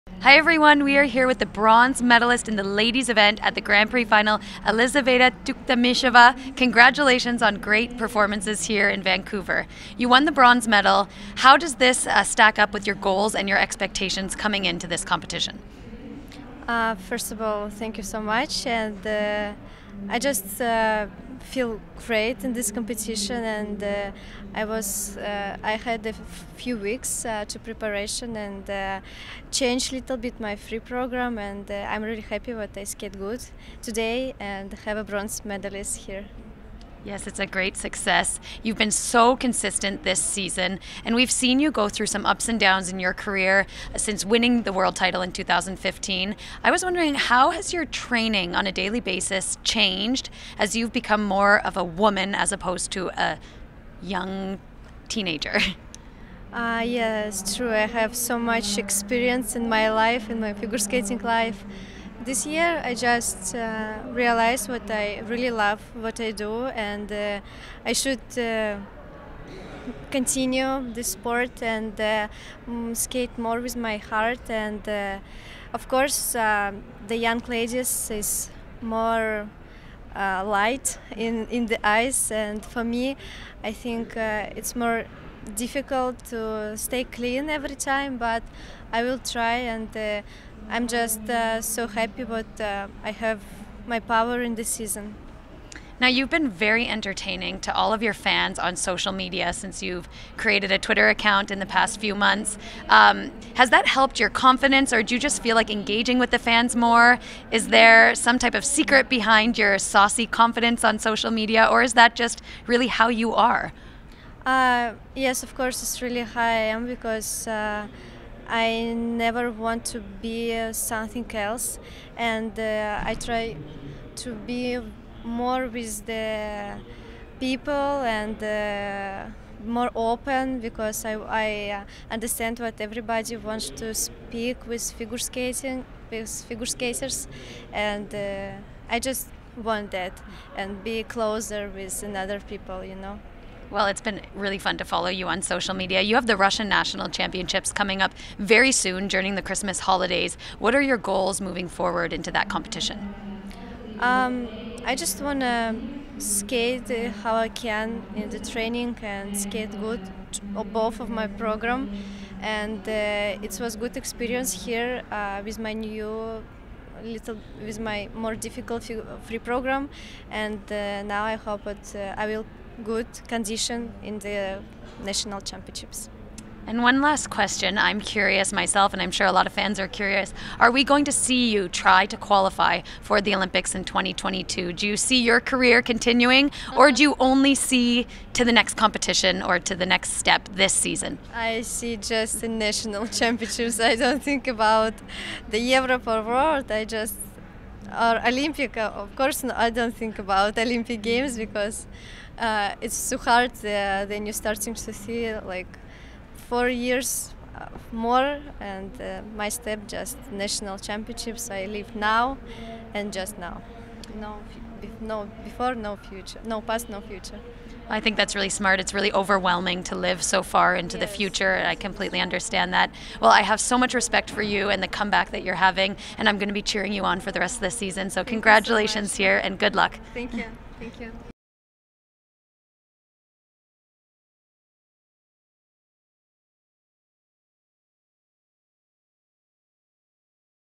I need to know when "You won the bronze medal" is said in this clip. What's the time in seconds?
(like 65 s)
9 s.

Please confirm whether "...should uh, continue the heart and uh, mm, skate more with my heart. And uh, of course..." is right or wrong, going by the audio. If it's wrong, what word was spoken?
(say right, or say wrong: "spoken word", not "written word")
wrong: "sport", not "heart".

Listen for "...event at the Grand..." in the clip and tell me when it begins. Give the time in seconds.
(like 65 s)
3 s.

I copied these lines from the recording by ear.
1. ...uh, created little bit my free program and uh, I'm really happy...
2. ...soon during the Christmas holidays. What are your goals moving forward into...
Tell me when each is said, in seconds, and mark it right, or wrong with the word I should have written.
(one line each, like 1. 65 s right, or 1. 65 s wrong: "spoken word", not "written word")
1. 28 s wrong: "changed", not "created"
2. 148 s right.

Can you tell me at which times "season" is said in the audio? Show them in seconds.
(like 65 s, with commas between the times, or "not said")
40 s, 94 s, 190 s, 227 s.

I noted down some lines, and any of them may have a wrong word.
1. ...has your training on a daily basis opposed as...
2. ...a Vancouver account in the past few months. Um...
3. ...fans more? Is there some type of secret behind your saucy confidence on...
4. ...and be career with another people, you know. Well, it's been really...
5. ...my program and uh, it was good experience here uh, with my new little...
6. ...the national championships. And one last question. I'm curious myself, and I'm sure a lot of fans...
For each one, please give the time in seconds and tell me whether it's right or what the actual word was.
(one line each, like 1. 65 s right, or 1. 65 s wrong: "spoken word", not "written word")
1. 47 s wrong: "changed", not "opposed"
2. 100 s wrong: "Twitter", not "Vancouver"
3. 106 s right
4. 140 s wrong: "closer", not "career"
5. 161 s right
6. 174 s right.